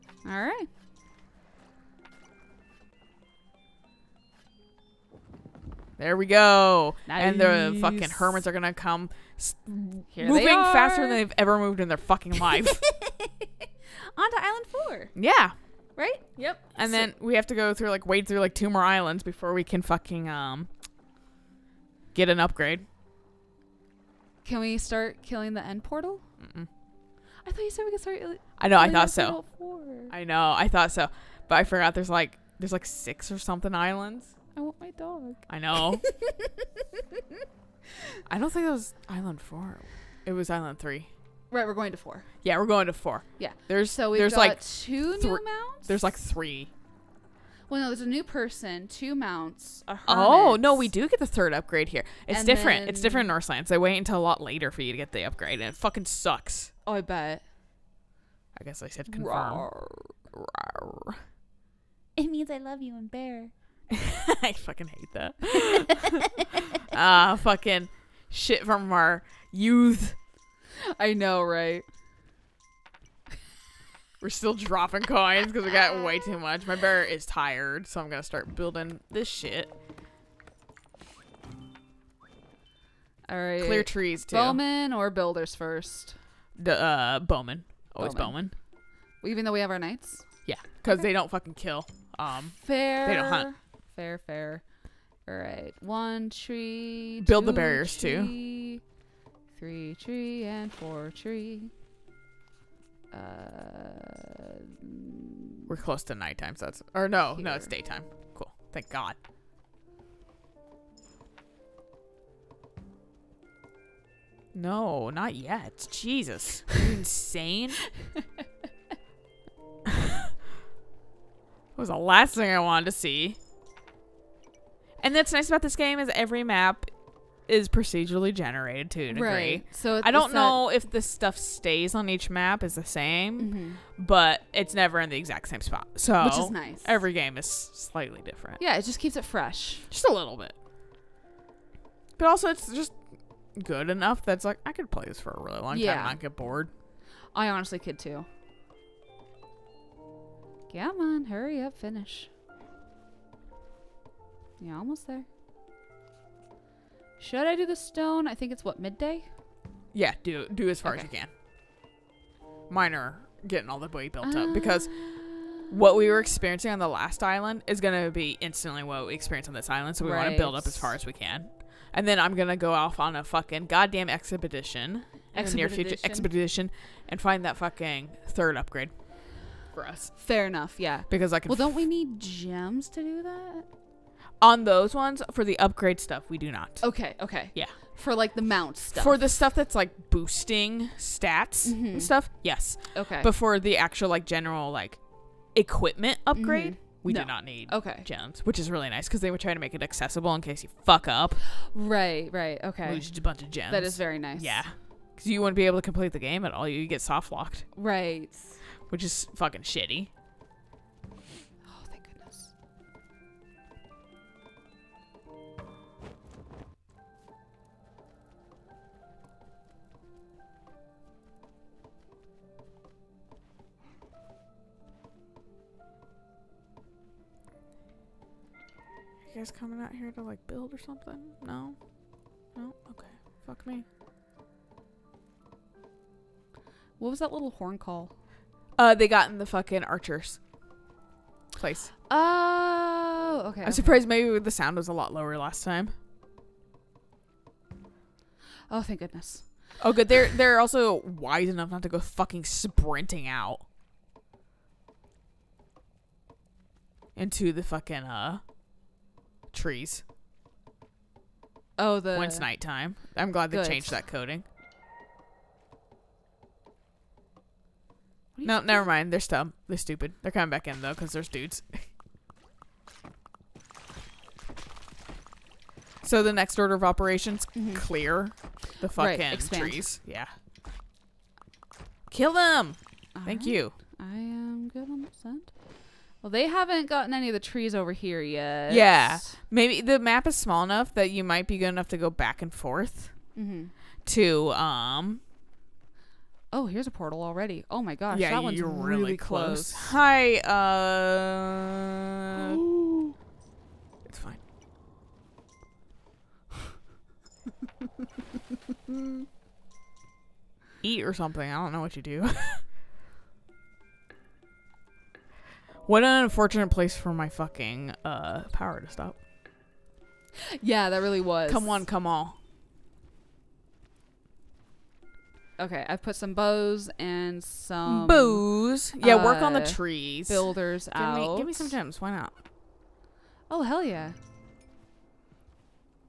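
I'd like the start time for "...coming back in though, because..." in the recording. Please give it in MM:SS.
04:30.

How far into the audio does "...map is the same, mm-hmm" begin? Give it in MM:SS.
02:12.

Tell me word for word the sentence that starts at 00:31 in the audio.
There's like there's like six or something islands.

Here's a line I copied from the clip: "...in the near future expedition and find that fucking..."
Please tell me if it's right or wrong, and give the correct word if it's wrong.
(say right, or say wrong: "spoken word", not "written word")
right.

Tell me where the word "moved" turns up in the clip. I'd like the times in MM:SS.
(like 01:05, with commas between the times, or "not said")
00:11.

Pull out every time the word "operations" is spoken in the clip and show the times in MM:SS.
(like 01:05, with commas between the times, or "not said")
04:36.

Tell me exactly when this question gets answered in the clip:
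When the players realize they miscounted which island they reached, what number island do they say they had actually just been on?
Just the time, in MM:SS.
00:40.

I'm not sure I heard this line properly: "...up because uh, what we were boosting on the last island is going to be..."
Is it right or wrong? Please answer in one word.
wrong.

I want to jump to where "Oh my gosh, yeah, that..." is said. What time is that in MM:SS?
04:57.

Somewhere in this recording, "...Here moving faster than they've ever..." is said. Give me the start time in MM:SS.
00:10.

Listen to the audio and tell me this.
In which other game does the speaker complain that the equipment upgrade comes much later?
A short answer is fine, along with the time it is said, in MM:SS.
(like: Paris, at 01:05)
Northlands, at 00:53.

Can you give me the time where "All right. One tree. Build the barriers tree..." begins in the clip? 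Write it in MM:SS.
01:35.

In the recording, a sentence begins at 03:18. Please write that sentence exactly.
gems, which is really nice because they were trying to make it accessible in case you fuck up.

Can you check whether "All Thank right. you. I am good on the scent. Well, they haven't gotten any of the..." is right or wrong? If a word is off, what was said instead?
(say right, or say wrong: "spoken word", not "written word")
right.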